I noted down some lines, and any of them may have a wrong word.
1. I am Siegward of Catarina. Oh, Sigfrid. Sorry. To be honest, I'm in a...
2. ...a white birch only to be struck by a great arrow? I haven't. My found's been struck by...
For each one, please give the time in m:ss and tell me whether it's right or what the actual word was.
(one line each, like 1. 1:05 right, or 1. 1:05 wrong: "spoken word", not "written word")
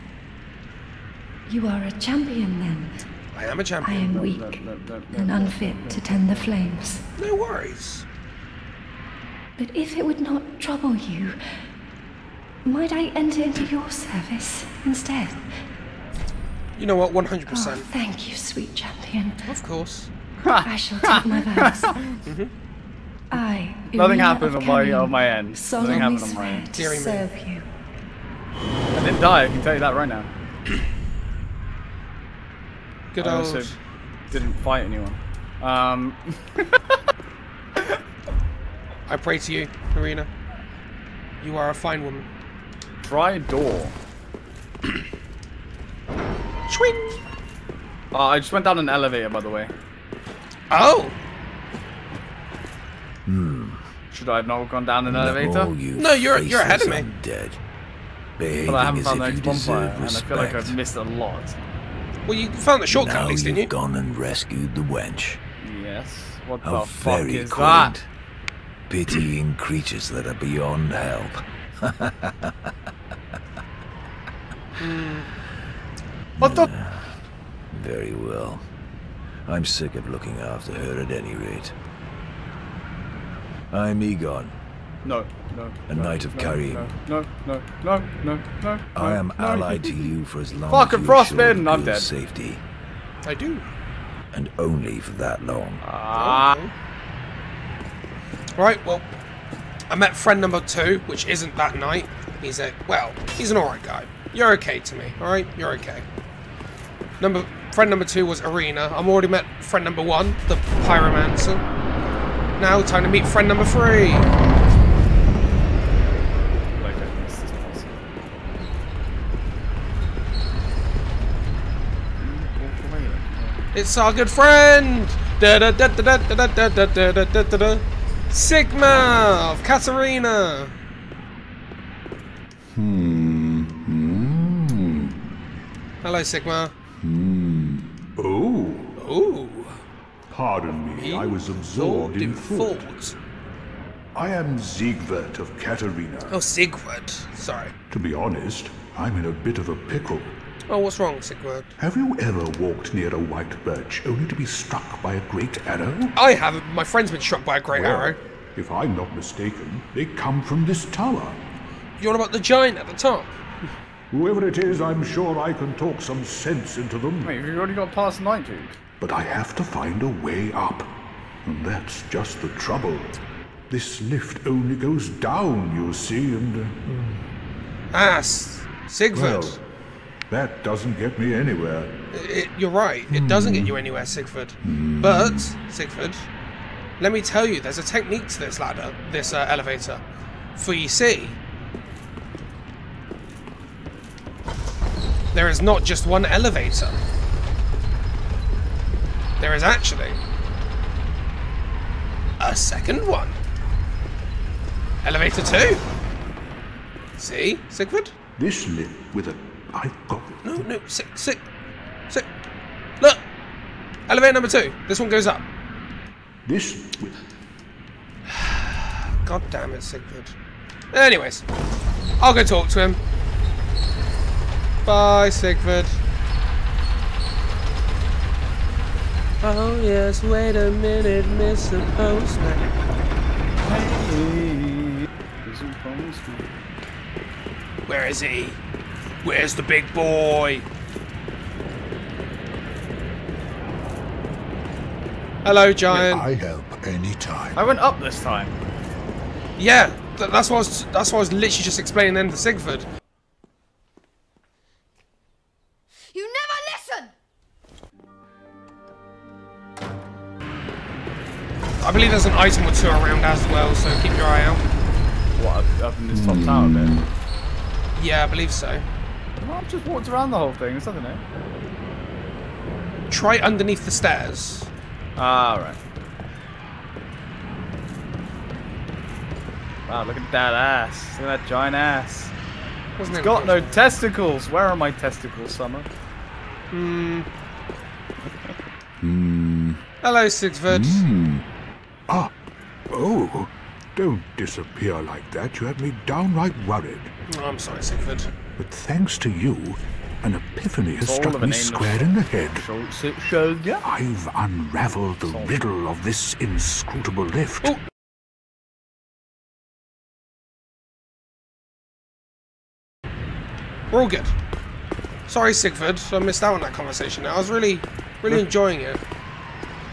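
1. 2:24 wrong: "Siegward", not "Sigfrid"
2. 2:33 wrong: "friend", not "found".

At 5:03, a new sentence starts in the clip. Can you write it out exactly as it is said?
I've unraveled the riddle of this inscrutable lift.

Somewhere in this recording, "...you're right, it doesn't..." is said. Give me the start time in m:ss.
3:02.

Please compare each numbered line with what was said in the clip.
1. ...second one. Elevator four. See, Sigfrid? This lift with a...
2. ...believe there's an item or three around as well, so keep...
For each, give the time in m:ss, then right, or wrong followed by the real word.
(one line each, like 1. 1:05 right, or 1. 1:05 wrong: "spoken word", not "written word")
1. 3:22 wrong: "two", not "four"
2. 4:21 wrong: "two", not "three".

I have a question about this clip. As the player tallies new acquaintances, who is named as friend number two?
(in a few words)
Irina.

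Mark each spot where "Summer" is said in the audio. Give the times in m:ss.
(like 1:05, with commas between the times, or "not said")
4:45.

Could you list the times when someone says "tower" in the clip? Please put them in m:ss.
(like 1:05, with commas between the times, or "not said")
2:40, 4:26.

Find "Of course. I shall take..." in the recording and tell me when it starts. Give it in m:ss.
0:19.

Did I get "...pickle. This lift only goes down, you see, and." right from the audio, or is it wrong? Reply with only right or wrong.
wrong.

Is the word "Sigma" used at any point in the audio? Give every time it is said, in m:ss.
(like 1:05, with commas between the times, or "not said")
2:08, 2:16.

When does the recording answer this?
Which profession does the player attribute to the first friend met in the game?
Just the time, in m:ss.
1:50.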